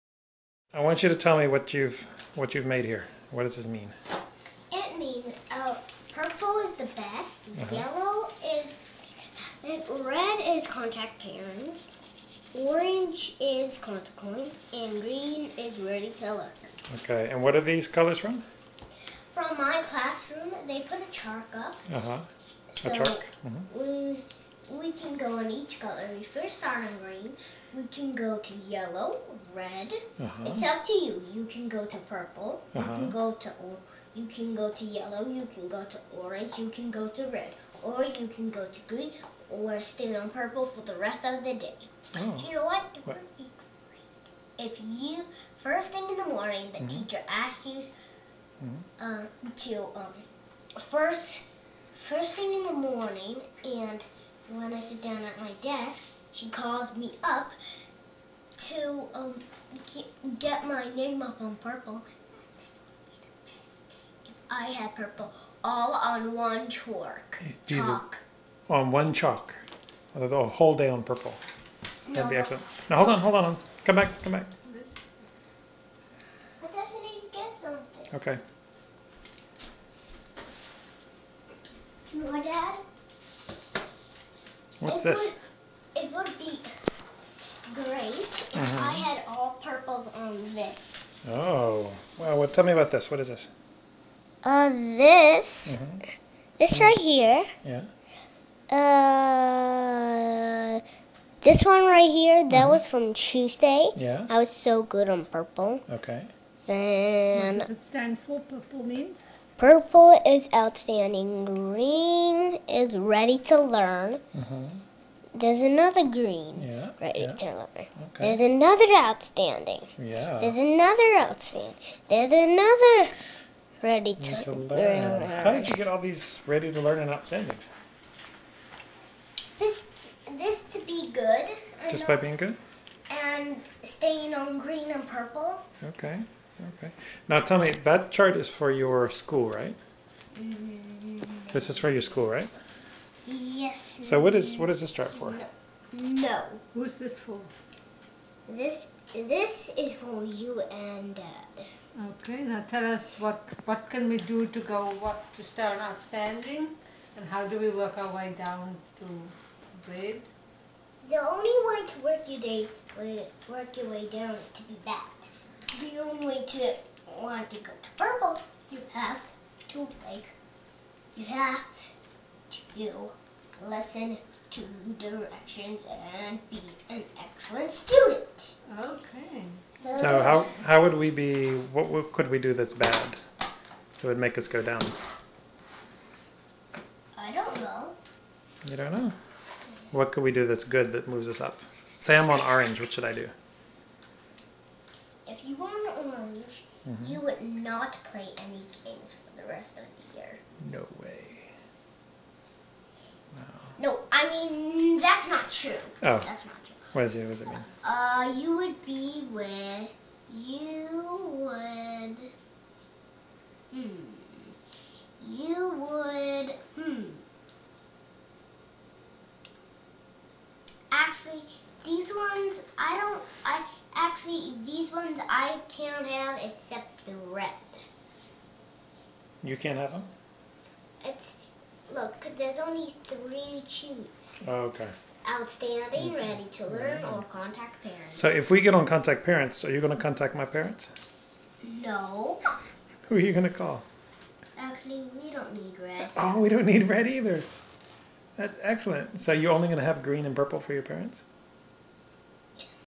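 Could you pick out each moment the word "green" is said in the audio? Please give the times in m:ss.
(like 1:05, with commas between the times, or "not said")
0:15, 0:27, 0:38, 1:51, 1:56, 2:14, 4:10.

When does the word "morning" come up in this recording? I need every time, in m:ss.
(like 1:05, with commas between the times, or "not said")
0:46, 0:52.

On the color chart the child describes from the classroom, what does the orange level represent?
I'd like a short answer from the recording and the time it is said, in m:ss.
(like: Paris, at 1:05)
Consequence, at 0:13.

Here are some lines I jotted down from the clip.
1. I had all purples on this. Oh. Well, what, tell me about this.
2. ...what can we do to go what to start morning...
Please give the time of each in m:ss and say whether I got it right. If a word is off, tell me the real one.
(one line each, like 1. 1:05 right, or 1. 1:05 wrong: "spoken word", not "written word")
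1. 1:28 right
2. 2:33 wrong: "outstanding", not "morning".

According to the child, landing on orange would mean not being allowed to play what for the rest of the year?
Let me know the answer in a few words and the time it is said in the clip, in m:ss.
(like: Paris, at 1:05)
Games, at 3:18.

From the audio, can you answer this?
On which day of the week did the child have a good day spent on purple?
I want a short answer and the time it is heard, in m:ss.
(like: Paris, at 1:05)
Tuesday, at 1:43.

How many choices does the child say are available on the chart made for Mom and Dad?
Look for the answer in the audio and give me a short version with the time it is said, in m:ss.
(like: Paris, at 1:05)
3, at 3:53.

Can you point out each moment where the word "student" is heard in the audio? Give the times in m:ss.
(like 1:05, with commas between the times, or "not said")
2:57.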